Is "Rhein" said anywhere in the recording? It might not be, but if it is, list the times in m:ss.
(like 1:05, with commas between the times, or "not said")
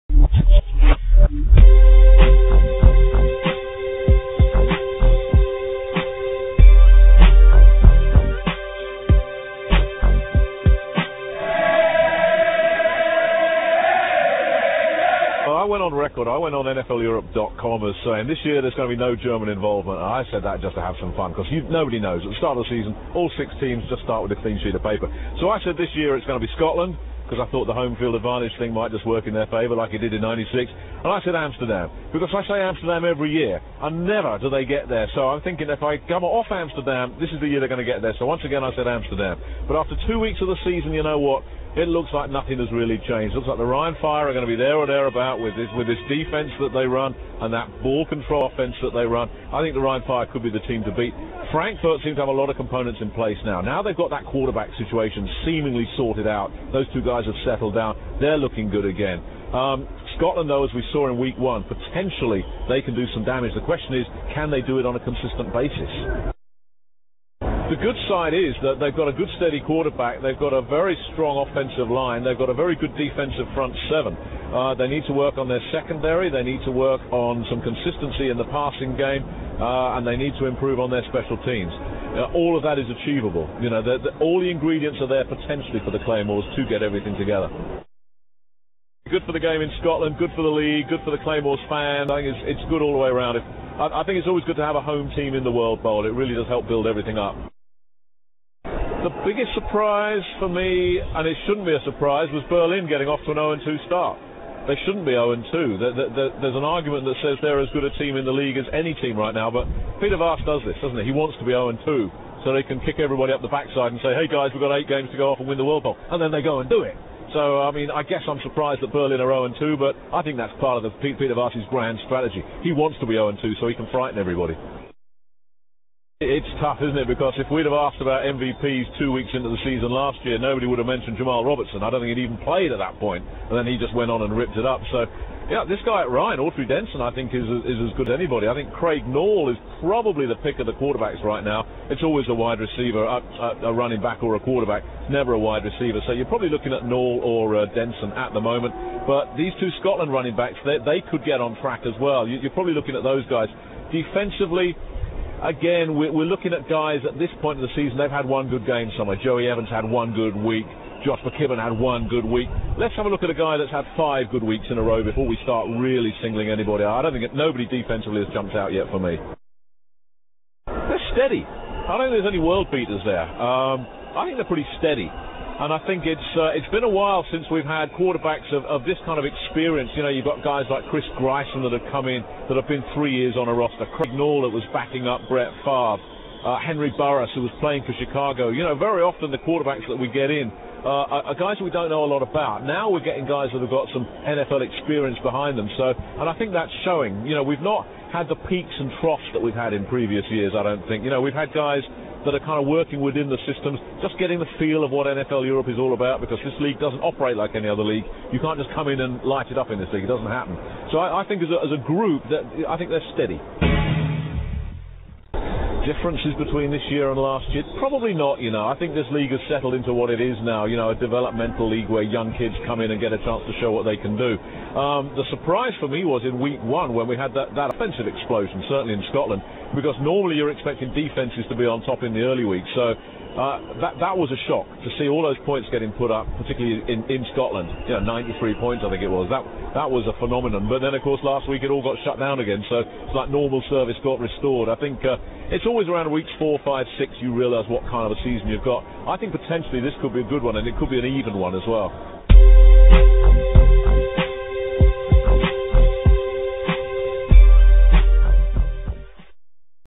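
0:43, 0:49, 2:16.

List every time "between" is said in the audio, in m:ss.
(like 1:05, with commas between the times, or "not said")
3:36.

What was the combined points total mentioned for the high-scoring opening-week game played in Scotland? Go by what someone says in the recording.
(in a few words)
93.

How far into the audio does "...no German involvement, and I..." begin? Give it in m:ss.
0:18.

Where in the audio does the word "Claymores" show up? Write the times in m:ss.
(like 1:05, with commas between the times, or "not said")
1:26, 1:31.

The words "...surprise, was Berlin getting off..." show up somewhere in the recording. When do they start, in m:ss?
1:41.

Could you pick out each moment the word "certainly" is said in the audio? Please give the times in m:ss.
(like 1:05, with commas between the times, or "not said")
3:48.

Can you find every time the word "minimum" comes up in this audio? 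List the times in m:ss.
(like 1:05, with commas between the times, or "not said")
not said.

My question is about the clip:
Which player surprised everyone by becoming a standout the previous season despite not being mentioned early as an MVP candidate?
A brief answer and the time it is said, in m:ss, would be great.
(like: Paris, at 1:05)
Jamal Robertson, at 2:11.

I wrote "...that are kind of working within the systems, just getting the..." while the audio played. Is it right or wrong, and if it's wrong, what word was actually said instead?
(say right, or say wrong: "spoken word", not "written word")
right.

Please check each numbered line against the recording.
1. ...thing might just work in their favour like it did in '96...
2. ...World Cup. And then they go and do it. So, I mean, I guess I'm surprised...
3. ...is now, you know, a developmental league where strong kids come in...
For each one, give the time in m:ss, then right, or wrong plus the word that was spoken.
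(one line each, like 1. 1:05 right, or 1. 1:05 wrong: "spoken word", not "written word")
1. 0:28 right
2. 1:55 right
3. 3:40 wrong: "young", not "strong".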